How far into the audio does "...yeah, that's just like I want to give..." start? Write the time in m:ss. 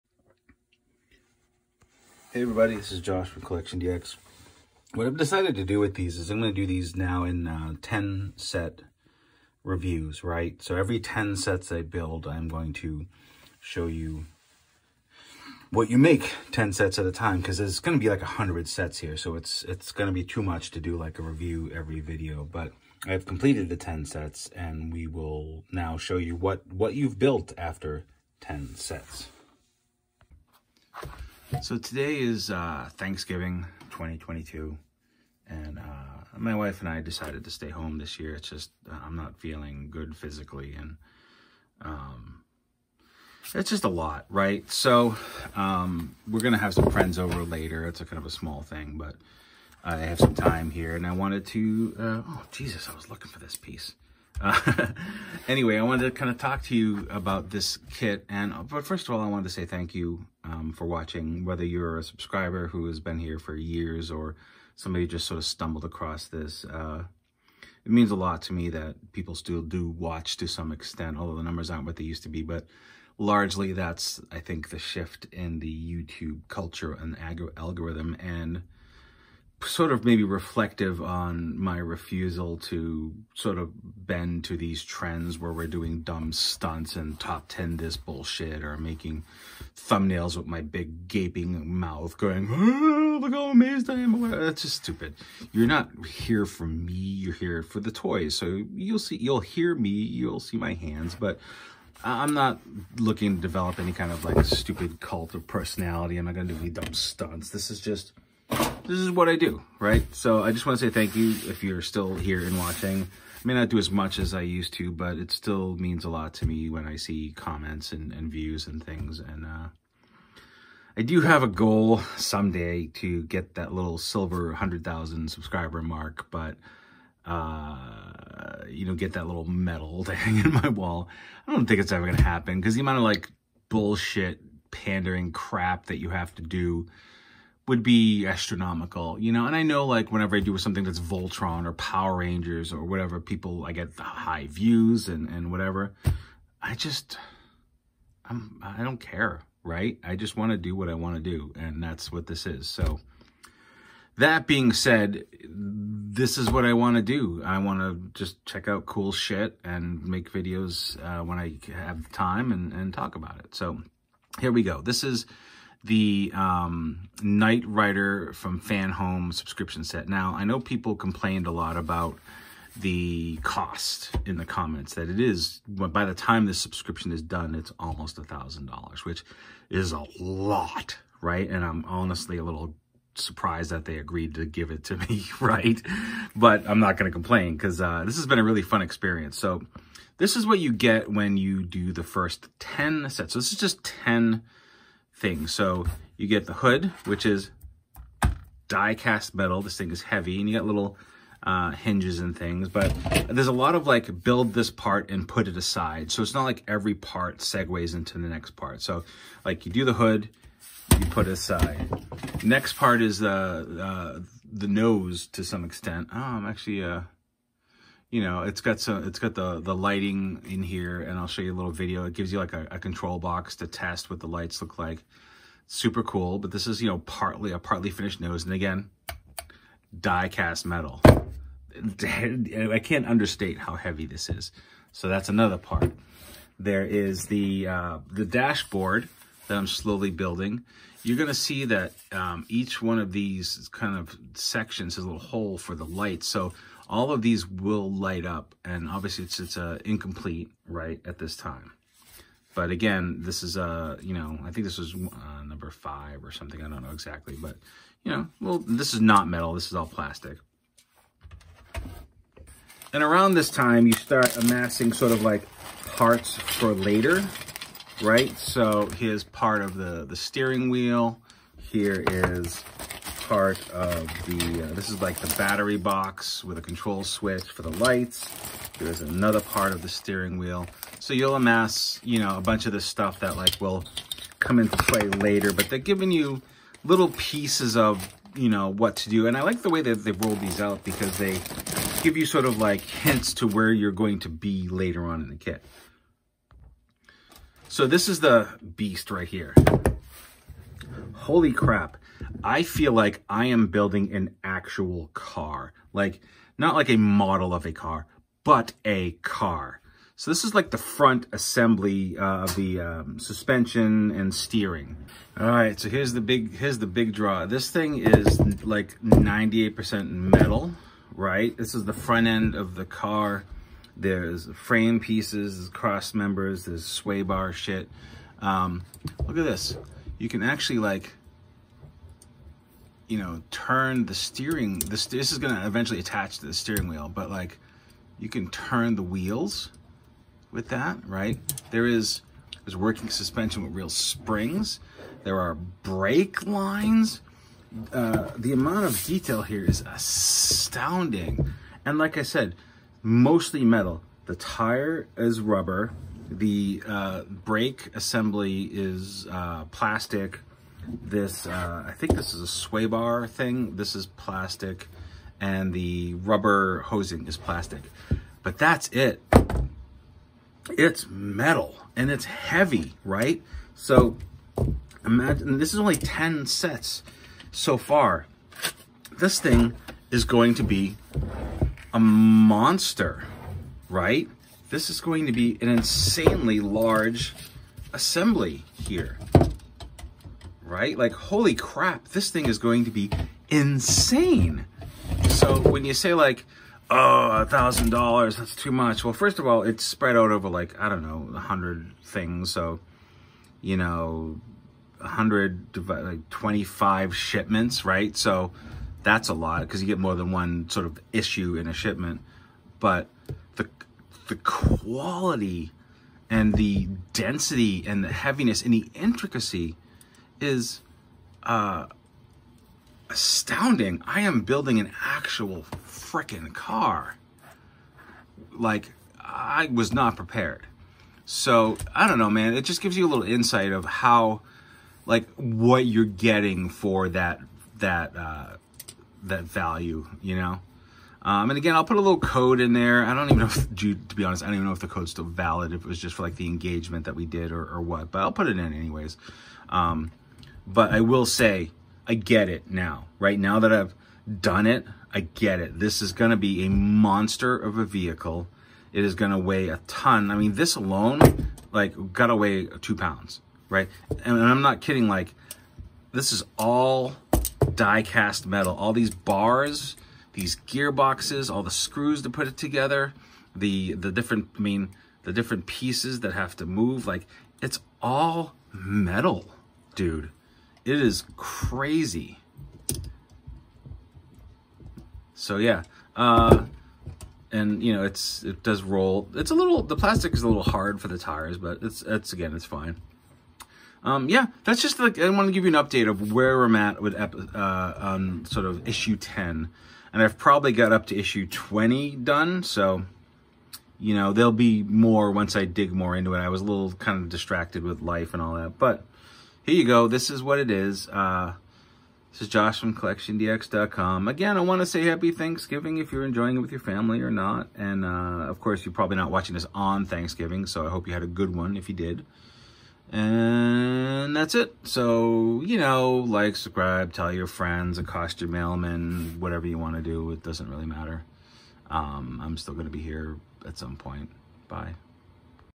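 8:14.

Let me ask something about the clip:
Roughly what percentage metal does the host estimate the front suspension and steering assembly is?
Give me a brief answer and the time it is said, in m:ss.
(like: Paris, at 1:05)
98%, at 5:19.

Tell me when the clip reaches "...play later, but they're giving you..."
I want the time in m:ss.
4:44.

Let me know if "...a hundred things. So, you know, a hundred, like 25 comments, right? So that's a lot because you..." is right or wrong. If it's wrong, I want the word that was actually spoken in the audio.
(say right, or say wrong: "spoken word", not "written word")
wrong: "shipments", not "comments".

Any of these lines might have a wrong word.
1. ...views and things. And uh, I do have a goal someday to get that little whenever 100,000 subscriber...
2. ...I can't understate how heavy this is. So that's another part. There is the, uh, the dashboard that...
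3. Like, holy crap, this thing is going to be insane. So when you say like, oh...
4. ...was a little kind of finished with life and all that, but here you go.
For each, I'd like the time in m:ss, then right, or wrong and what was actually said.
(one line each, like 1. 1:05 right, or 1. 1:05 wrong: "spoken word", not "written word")
1. 1:58 wrong: "silver", not "whenever"
2. 3:51 right
3. 6:30 right
4. 8:26 wrong: "distracted", not "finished".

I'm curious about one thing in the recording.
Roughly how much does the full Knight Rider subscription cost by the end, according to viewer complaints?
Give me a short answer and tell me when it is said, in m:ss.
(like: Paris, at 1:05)
almost $1,000, at 2:57.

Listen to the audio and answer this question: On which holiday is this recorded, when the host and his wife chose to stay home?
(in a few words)
Thanksgiving 2022.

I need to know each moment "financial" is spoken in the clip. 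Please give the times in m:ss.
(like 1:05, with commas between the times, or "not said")
not said.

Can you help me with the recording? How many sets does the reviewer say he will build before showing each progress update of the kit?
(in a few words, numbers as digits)
10.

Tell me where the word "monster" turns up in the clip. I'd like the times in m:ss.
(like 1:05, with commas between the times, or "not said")
6:21, 7:36.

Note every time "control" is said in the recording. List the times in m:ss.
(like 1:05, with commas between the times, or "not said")
3:42, 4:36.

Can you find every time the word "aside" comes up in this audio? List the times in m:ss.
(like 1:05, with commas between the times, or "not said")
3:25, 3:31.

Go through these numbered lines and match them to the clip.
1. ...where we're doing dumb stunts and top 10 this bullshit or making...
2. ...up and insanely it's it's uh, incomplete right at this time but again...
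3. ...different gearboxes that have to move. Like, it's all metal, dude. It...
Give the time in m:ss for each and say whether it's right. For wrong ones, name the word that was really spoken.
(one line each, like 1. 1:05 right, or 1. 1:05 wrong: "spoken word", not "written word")
1. 1:25 right
2. 4:08 wrong: "obviously", not "insanely"
3. 7:55 wrong: "pieces", not "gearboxes".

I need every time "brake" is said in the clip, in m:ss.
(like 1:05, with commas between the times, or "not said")
5:45, 5:57.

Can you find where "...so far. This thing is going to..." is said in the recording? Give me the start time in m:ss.
6:17.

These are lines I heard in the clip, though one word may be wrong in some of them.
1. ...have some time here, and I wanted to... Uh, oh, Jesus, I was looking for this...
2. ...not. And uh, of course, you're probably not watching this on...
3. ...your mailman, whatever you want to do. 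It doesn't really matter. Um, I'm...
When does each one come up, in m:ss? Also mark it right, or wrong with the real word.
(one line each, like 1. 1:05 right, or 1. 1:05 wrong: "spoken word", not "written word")
1. 0:49 right
2. 8:37 right
3. 8:48 right.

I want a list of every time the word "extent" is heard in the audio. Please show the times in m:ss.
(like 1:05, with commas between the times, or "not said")
1:10, 3:35.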